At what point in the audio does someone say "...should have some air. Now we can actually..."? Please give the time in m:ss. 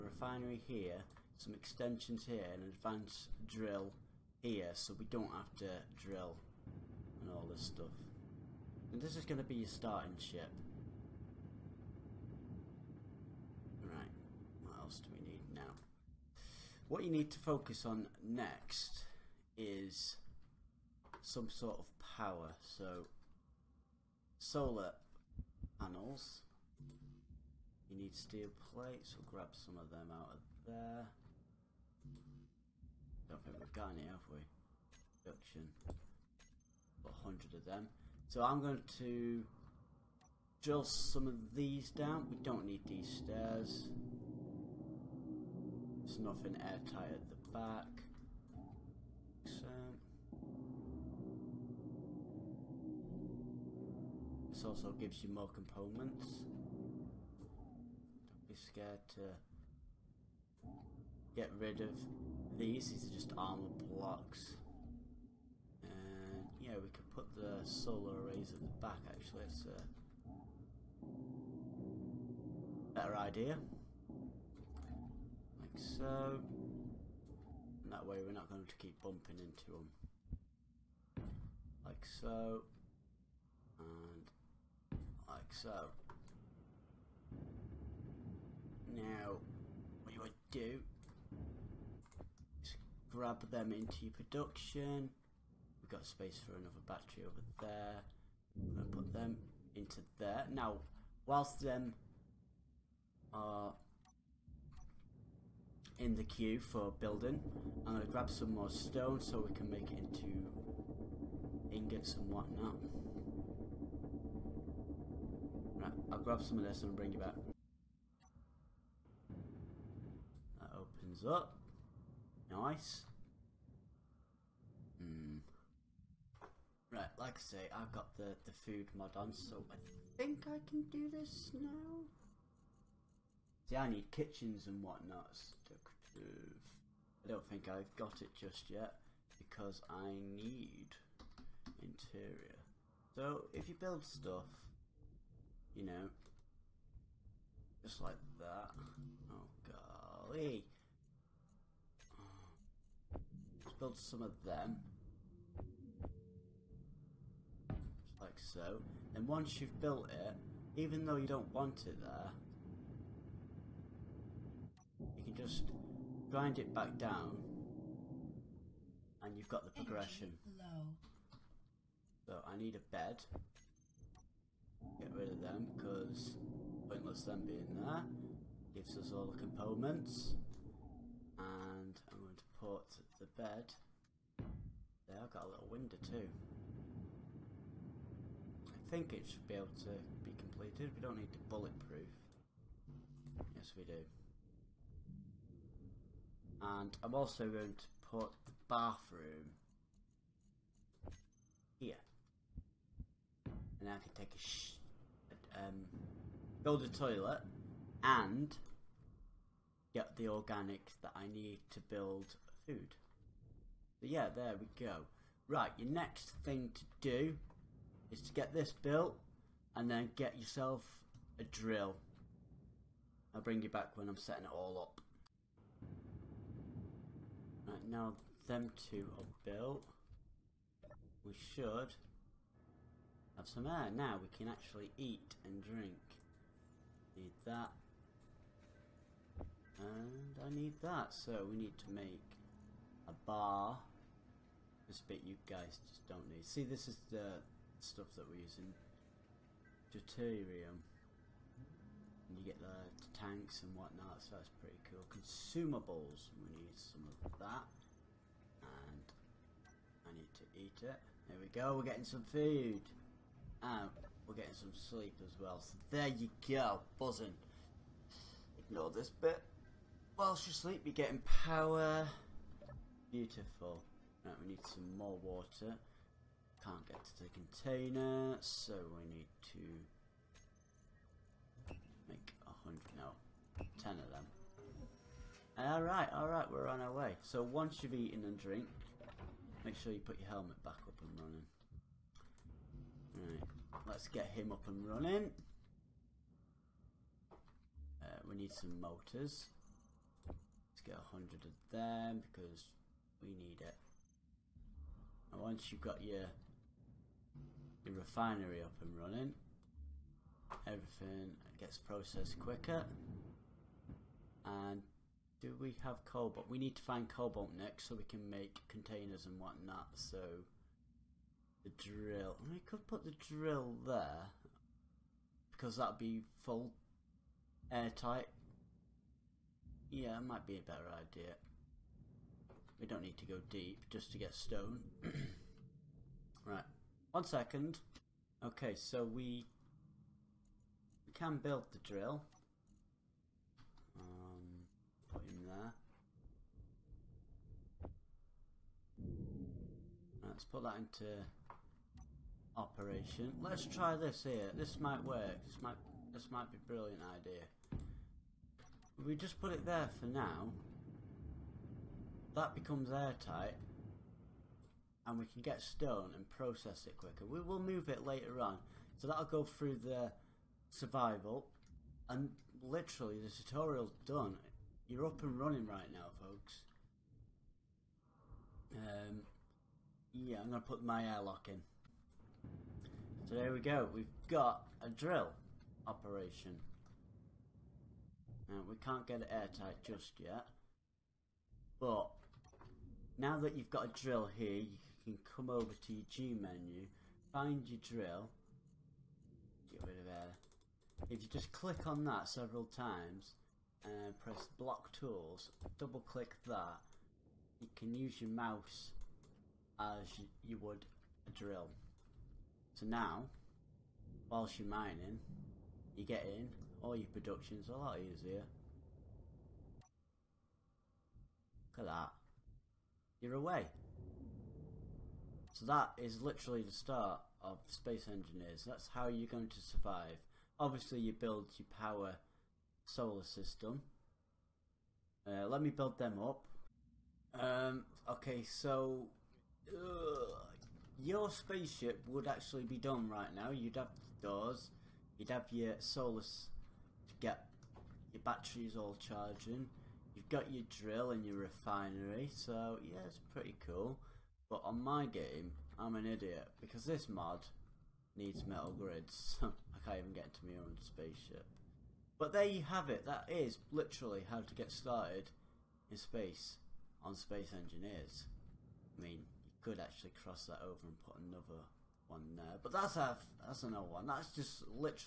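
3:51.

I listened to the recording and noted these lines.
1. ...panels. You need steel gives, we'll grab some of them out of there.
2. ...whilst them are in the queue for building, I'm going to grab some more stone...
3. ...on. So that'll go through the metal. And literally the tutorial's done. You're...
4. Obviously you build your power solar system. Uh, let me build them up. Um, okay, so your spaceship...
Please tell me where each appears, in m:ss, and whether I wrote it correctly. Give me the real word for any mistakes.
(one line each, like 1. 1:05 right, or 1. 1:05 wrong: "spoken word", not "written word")
1. 0:25 wrong: "plates", not "gives"
2. 1:41 right
3. 6:08 wrong: "survival", not "metal"
4. 7:10 right.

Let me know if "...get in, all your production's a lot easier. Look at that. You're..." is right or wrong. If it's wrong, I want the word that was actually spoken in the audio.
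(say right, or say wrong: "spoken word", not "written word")
right.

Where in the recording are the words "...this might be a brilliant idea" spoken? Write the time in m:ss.
5:56.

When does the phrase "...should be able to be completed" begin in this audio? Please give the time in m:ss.
3:09.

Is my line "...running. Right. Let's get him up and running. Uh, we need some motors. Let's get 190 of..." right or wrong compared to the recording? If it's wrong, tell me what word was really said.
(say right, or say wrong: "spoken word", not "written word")
wrong: "100", not "190".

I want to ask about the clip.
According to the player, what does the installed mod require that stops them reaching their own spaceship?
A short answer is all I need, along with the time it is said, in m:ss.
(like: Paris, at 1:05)
Metal grids, at 7:38.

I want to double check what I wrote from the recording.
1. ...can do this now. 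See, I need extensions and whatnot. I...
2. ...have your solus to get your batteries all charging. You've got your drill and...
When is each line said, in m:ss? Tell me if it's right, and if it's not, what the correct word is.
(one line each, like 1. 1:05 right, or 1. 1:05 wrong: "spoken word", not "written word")
1. 2:10 wrong: "kitchens", not "extensions"
2. 7:25 right.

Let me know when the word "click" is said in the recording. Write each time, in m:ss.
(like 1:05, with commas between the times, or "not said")
6:41, 6:46.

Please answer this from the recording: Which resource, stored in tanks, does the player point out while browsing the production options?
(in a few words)
Deuterium.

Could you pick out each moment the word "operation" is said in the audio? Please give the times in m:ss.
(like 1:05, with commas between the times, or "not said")
5:52, 6:25.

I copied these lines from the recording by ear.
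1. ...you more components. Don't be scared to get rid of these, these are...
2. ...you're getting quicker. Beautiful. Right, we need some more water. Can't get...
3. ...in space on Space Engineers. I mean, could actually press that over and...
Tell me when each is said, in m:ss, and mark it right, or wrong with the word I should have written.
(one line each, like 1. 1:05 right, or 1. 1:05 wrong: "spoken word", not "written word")
1. 0:55 right
2. 4:30 wrong: "power", not "quicker"
3. 7:45 wrong: "cross", not "press".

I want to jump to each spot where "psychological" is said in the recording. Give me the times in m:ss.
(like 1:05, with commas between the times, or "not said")
not said.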